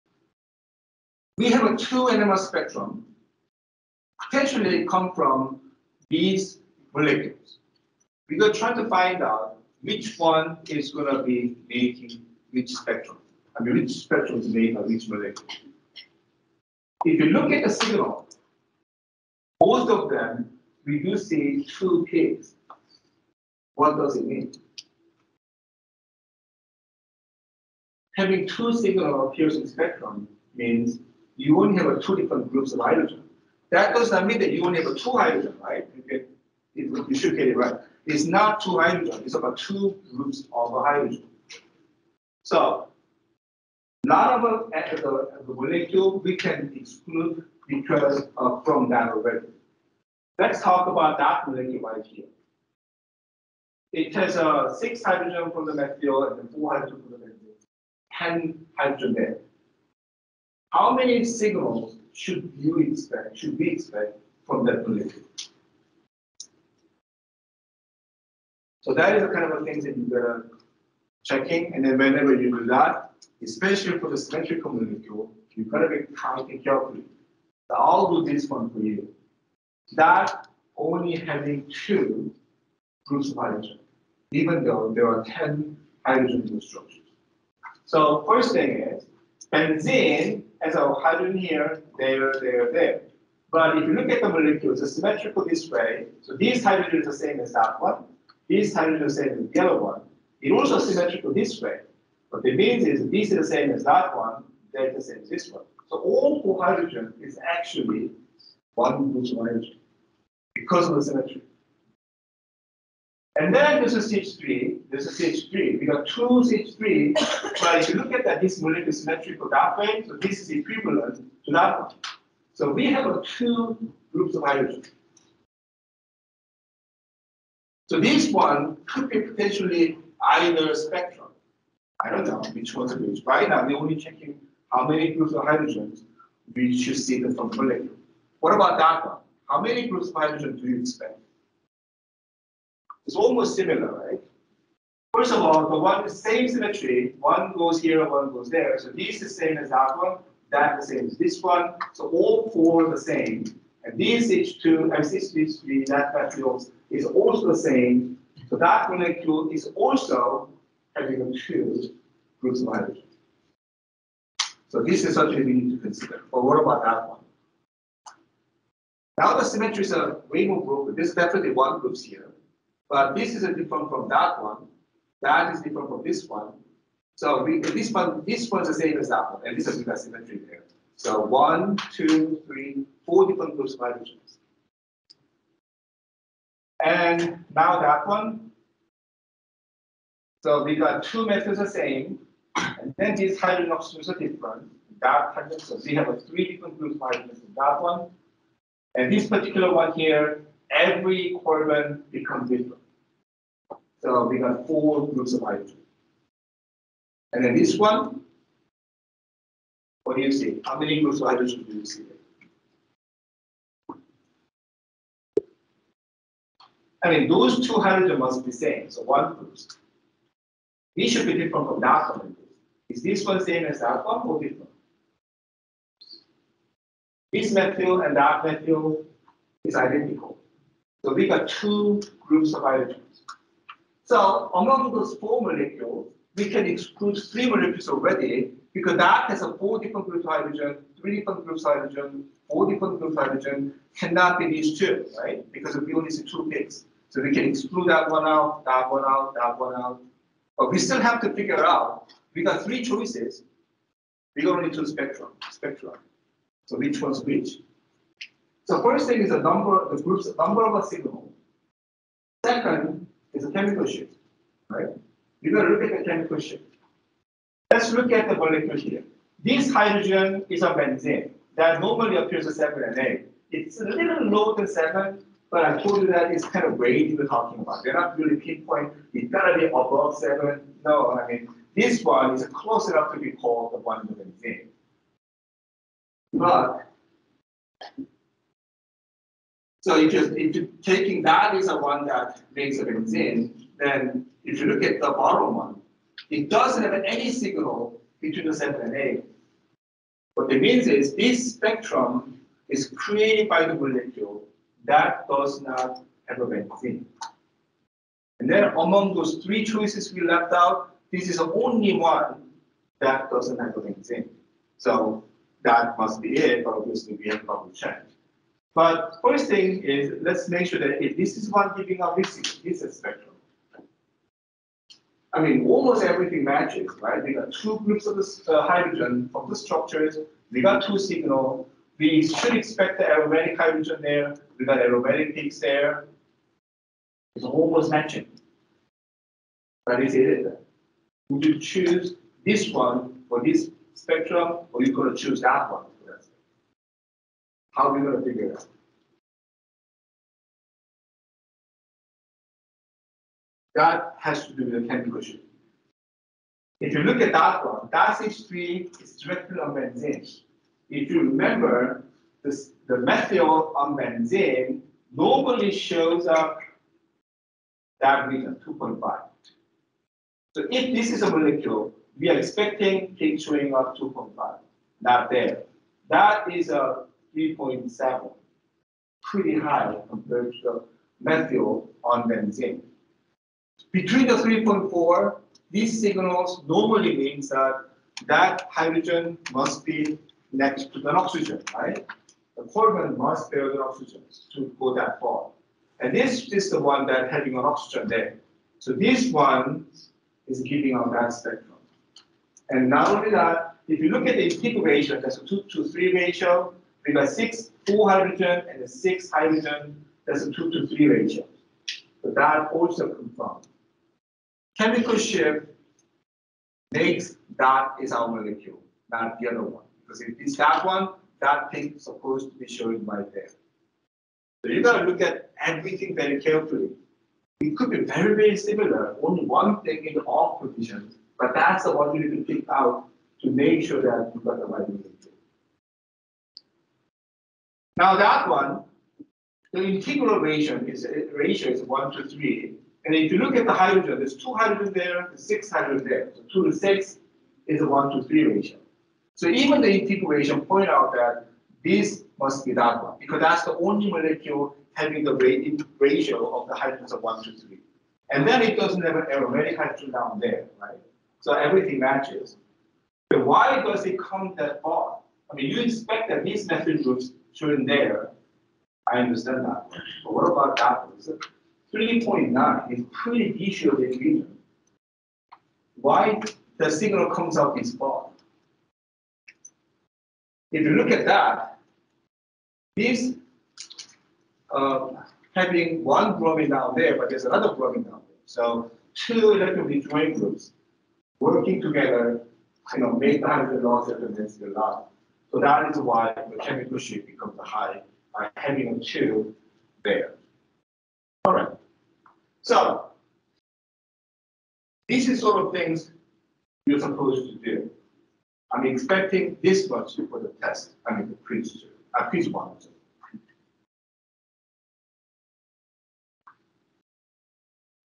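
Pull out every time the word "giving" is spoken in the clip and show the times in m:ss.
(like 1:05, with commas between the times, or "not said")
5:21, 6:40.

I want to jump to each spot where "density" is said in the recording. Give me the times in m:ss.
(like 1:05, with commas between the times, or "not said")
8:14.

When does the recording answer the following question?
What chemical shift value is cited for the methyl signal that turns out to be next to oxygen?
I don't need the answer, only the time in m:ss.
6:17.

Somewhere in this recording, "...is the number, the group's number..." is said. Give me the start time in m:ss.
4:19.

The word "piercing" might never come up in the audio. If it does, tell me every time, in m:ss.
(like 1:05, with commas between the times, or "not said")
0:29.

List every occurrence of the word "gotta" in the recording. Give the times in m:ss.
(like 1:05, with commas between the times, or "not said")
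7:04.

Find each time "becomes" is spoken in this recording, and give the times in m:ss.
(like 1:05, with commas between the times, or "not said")
3:22, 8:17.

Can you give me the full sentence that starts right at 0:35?
You, get, you should get it right.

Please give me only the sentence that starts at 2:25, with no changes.
First of all, the one same symmetry, one goes here, one goes there.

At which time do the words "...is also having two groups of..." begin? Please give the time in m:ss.
2:39.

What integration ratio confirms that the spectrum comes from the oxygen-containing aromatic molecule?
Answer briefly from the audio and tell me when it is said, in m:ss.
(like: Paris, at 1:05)
2 to 3, at 6:45.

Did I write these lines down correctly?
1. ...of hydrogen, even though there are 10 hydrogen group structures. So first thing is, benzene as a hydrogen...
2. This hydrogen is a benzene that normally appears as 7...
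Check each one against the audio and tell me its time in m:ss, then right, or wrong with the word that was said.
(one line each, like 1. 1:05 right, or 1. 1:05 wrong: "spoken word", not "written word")
1. 1:23 right
2. 4:29 right.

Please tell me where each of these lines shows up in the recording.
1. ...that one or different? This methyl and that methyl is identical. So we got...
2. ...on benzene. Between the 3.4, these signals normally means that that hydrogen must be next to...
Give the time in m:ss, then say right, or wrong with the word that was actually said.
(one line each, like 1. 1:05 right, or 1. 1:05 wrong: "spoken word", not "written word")
1. 3:43 right
2. 6:22 right.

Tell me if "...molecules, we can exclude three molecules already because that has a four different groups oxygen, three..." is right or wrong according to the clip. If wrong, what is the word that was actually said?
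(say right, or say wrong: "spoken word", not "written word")
wrong: "hydrogen", not "oxygen".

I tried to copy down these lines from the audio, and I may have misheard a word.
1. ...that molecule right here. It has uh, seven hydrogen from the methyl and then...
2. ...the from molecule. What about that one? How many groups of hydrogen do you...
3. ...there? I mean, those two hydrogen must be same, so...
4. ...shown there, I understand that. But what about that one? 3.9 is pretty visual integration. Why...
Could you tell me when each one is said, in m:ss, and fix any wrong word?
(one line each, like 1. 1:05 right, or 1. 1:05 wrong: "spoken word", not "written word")
1. 0:51 wrong: "six", not "seven"
2. 2:17 right
3. 3:32 right
4. 7:47 wrong: "region", not "integration".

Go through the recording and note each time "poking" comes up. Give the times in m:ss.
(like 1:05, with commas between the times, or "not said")
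not said.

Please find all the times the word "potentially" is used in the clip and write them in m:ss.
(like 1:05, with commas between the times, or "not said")
0:04, 2:09.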